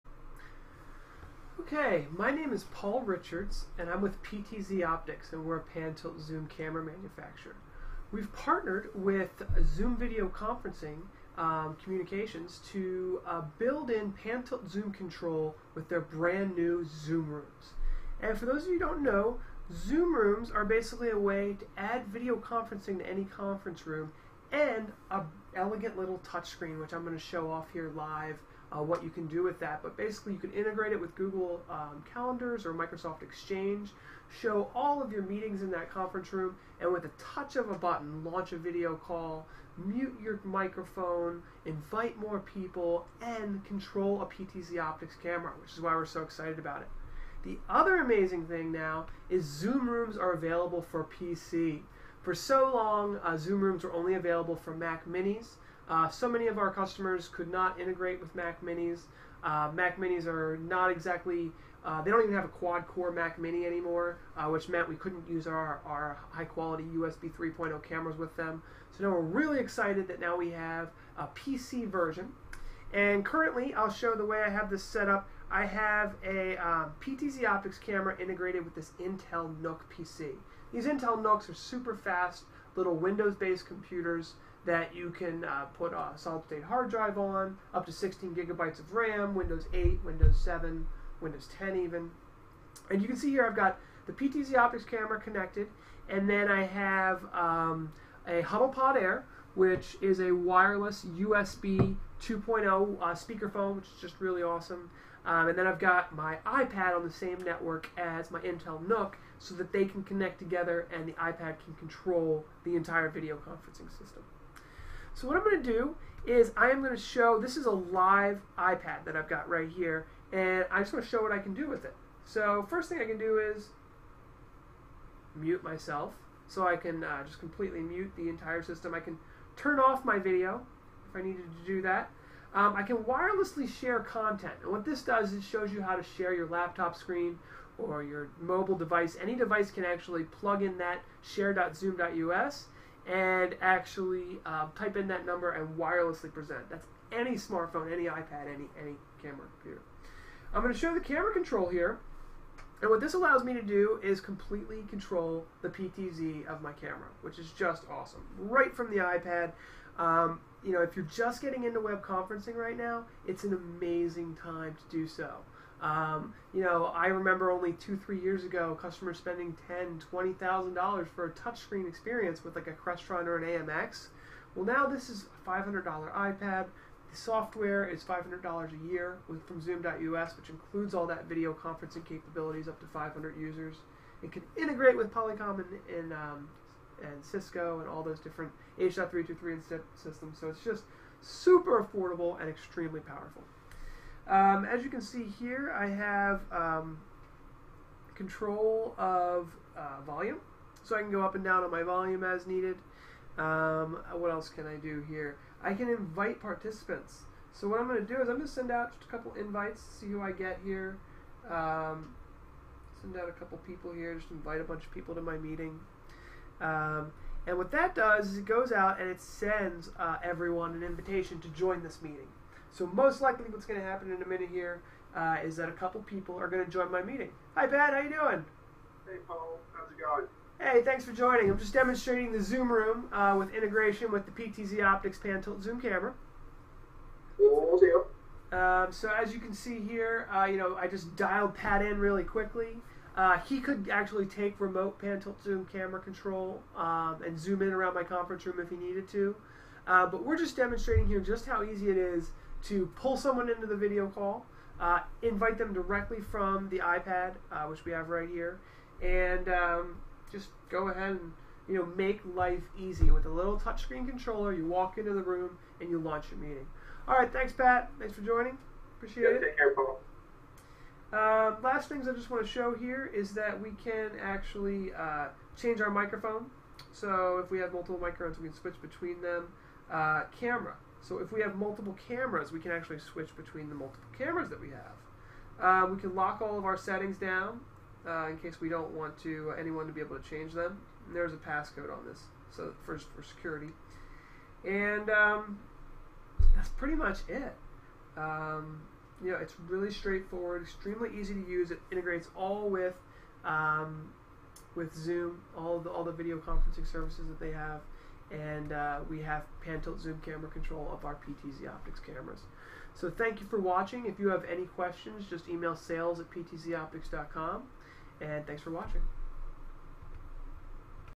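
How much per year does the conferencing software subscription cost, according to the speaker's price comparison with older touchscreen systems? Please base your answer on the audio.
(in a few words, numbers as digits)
$500.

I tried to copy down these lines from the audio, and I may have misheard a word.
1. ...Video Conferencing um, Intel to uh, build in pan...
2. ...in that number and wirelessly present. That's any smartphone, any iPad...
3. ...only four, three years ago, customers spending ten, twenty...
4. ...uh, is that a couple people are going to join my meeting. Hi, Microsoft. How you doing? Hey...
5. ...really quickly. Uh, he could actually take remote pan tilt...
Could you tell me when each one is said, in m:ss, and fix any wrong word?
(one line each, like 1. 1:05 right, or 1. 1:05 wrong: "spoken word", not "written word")
1. 0:09 wrong: "Communications", not "Intel"
2. 2:24 right
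3. 2:47 wrong: "two", not "four"
4. 3:45 wrong: "Pat", not "Microsoft"
5. 4:01 right.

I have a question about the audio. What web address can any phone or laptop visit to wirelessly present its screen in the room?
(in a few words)
share.zoom.us.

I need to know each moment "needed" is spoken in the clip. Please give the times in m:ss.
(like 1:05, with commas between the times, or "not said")
2:11, 3:22, 4:08.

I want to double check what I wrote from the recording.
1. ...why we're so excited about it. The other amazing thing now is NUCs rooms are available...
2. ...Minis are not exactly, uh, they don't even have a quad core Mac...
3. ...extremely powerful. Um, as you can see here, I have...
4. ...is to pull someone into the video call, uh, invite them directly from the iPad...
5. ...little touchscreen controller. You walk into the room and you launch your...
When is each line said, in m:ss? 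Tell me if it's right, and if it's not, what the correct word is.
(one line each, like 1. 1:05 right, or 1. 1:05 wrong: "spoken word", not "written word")
1. 0:45 wrong: "Zoom", not "NUCs"
2. 0:59 right
3. 3:12 right
4. 4:11 right
5. 4:23 right.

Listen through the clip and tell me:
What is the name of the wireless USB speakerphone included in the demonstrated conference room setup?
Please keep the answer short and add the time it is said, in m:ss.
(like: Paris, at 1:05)
HuddlePod Air, at 1:38.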